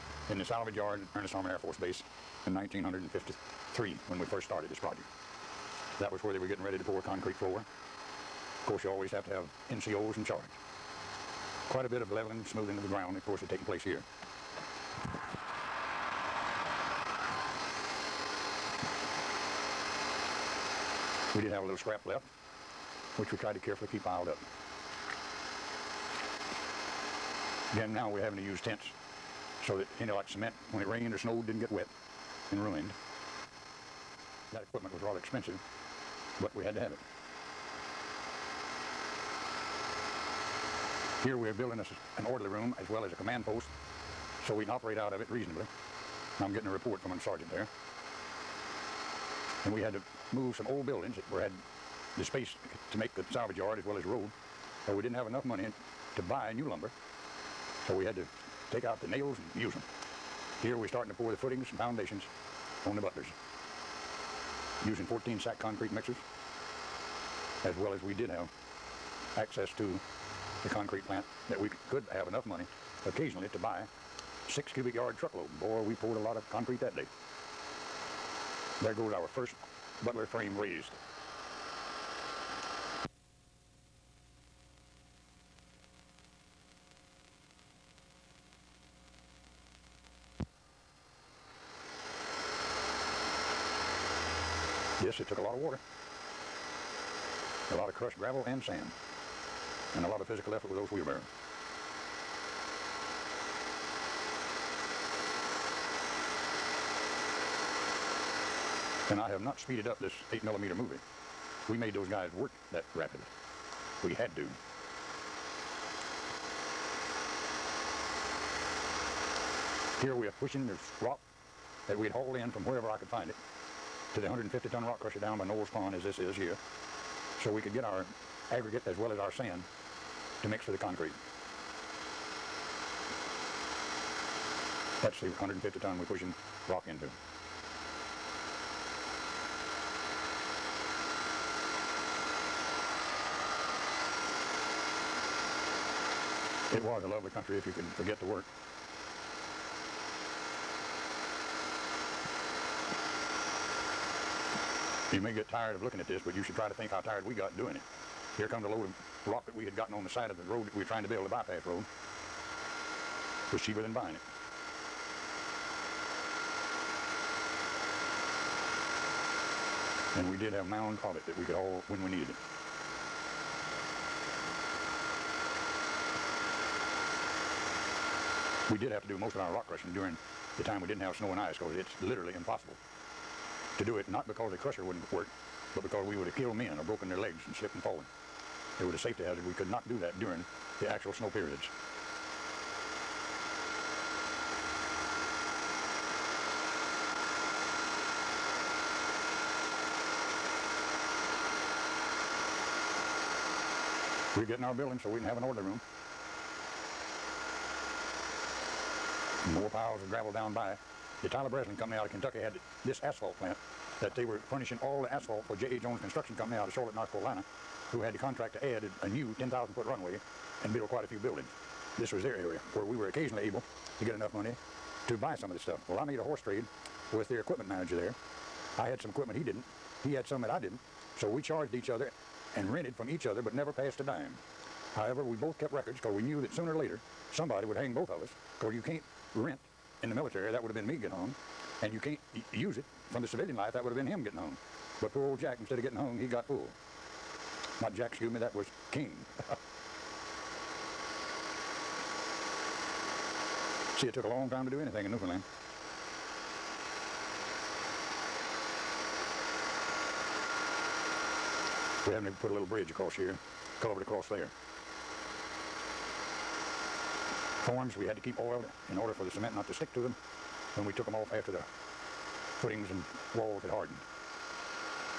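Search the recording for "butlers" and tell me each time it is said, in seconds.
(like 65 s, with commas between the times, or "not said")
62 s, 80 s.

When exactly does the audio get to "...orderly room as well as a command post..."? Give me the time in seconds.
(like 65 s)
42 s.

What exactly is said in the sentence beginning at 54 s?
So we didn't have enough money to buy new lumber.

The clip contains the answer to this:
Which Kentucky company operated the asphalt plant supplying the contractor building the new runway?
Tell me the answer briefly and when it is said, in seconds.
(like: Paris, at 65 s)
Tyler Breslin Company, at 211 s.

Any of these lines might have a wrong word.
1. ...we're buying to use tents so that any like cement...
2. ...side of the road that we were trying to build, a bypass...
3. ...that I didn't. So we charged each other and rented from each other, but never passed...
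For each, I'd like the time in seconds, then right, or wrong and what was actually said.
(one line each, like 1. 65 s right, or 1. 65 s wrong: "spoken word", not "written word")
1. 28 s wrong: "having", not "buying"
2. 160 s right
3. 230 s right.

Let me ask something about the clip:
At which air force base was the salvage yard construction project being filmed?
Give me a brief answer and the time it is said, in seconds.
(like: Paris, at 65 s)
Ernest Harmon Air Force Base, at 1 s.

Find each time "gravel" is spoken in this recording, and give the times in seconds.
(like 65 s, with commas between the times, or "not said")
98 s, 210 s.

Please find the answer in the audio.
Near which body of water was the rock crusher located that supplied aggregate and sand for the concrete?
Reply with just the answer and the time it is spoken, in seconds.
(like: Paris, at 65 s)
Knowles Pond, at 125 s.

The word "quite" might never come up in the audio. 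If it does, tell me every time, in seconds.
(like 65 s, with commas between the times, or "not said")
11 s, 220 s.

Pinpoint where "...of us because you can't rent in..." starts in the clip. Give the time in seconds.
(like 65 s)
238 s.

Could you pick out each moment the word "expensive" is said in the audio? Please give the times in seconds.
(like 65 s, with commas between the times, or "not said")
35 s.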